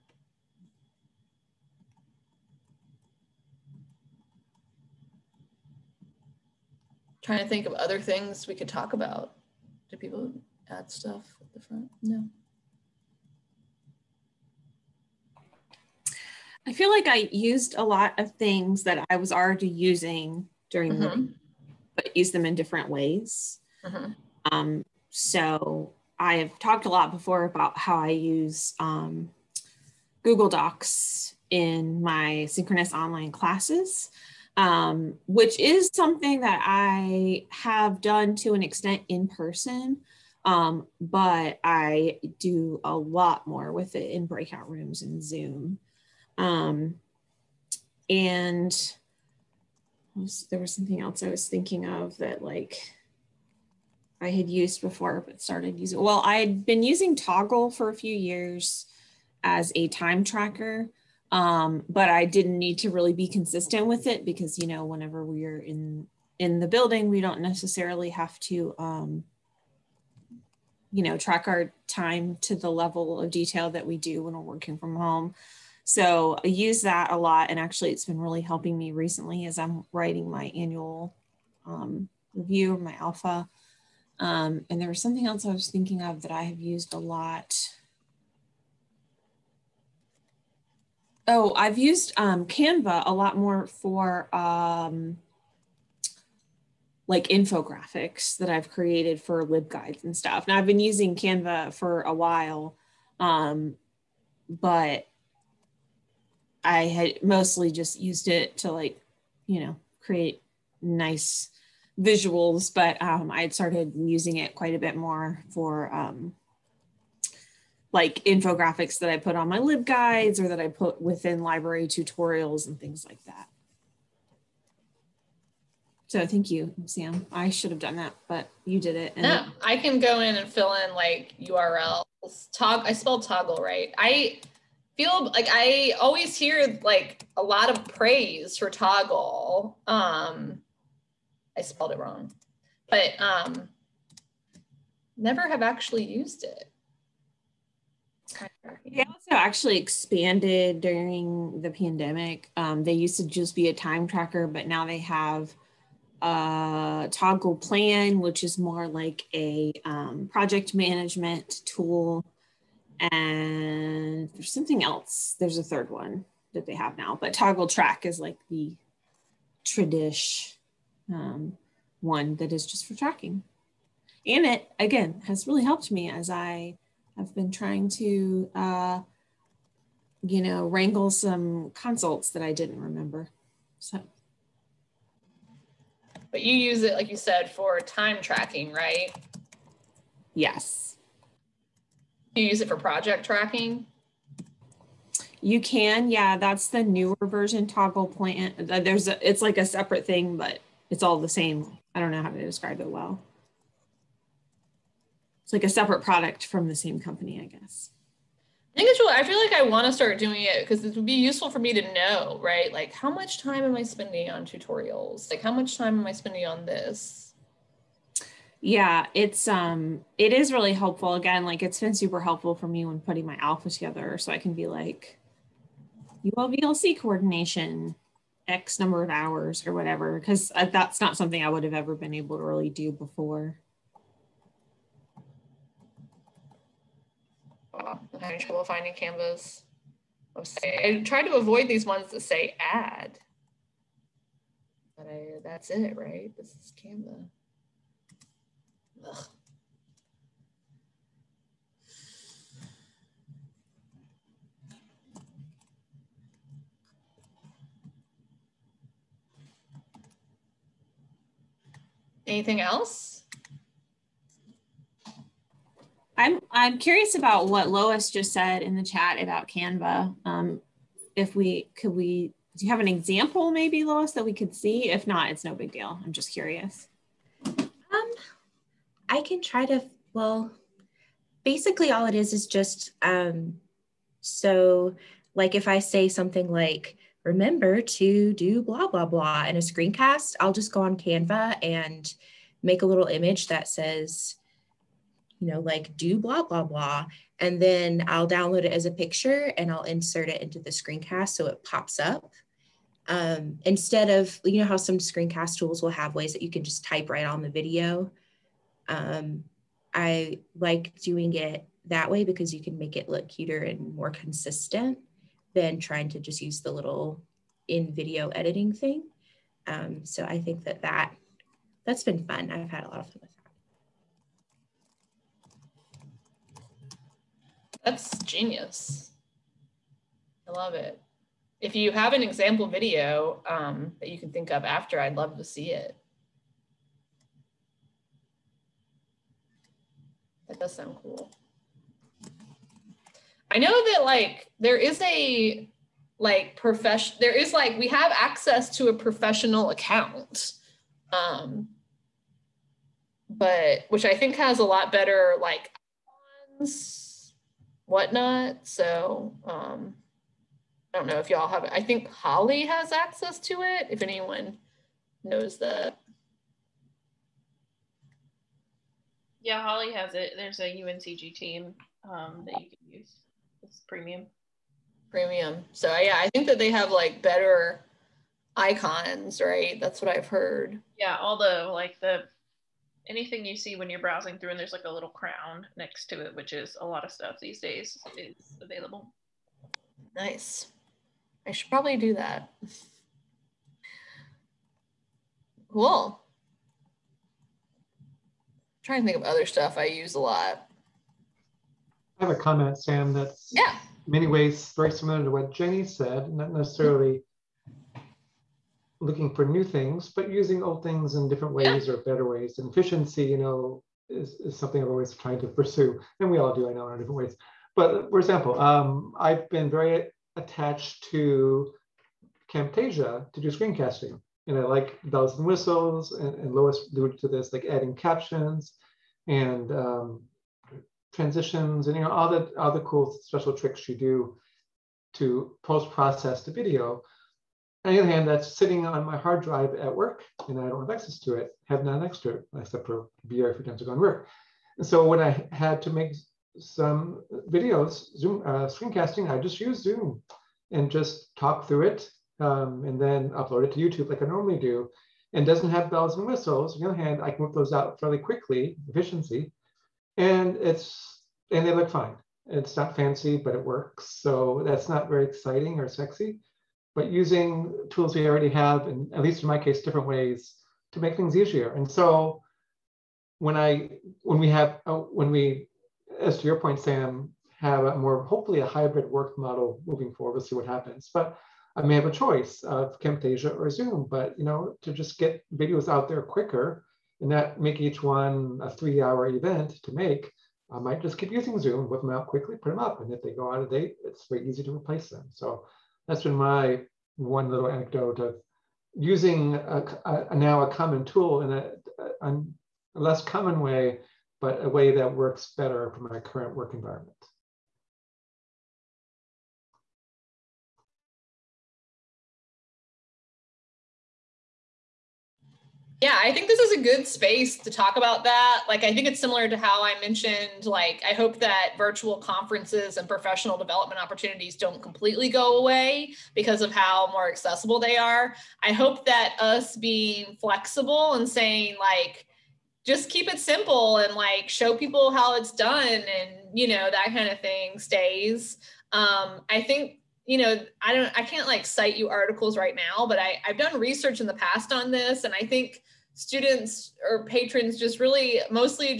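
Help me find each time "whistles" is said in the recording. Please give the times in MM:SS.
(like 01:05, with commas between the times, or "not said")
07:05, 07:36.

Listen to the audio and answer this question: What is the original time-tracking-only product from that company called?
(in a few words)
Toggl Track.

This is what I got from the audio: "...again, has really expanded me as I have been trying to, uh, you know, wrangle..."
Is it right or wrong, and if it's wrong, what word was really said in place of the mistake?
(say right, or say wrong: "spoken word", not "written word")
wrong: "helped", not "expanded".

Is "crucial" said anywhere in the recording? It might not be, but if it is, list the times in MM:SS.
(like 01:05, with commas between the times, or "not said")
not said.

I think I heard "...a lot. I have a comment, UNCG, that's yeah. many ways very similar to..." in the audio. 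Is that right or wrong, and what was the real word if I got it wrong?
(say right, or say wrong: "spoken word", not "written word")
wrong: "Sam", not "UNCG".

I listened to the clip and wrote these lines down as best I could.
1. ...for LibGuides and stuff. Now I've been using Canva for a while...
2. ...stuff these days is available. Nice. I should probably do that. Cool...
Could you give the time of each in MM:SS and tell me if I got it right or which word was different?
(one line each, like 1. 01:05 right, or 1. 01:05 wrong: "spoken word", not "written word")
1. 01:39 right
2. 06:27 right.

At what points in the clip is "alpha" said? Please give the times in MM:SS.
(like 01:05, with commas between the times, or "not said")
01:22, 03:43.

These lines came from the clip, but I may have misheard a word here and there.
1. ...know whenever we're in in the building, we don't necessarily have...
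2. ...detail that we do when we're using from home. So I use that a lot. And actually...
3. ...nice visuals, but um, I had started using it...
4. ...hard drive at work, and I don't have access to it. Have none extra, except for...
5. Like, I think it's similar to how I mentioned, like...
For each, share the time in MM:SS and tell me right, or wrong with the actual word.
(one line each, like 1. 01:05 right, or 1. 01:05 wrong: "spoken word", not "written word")
1. 01:04 right
2. 01:13 wrong: "working", not "using"
3. 01:50 right
4. 07:19 right
5. 08:38 right.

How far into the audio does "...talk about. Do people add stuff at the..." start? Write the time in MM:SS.
00:08.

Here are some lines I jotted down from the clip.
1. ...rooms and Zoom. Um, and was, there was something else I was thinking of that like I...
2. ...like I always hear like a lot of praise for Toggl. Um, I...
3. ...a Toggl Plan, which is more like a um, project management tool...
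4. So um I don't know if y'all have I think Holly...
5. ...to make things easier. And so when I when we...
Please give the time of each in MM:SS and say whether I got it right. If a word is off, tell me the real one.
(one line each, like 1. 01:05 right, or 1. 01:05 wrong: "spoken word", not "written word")
1. 00:44 right
2. 02:15 right
3. 02:36 right
4. 05:58 right
5. 07:50 right.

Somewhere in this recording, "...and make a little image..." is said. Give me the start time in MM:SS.
04:51.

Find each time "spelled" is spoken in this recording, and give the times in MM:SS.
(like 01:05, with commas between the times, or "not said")
02:12, 02:21.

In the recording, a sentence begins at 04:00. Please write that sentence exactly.
I try to avoid these ones that say add, but I, that's it, right?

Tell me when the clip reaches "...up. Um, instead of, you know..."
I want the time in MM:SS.
05:01.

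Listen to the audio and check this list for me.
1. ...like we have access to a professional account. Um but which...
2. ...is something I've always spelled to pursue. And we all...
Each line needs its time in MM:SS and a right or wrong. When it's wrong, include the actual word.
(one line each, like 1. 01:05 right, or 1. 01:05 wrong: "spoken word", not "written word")
1. 05:47 right
2. 06:54 wrong: "tried", not "spelled".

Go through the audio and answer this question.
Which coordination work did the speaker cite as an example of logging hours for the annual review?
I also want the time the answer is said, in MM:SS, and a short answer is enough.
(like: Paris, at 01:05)
ULVLC coordination, at 03:46.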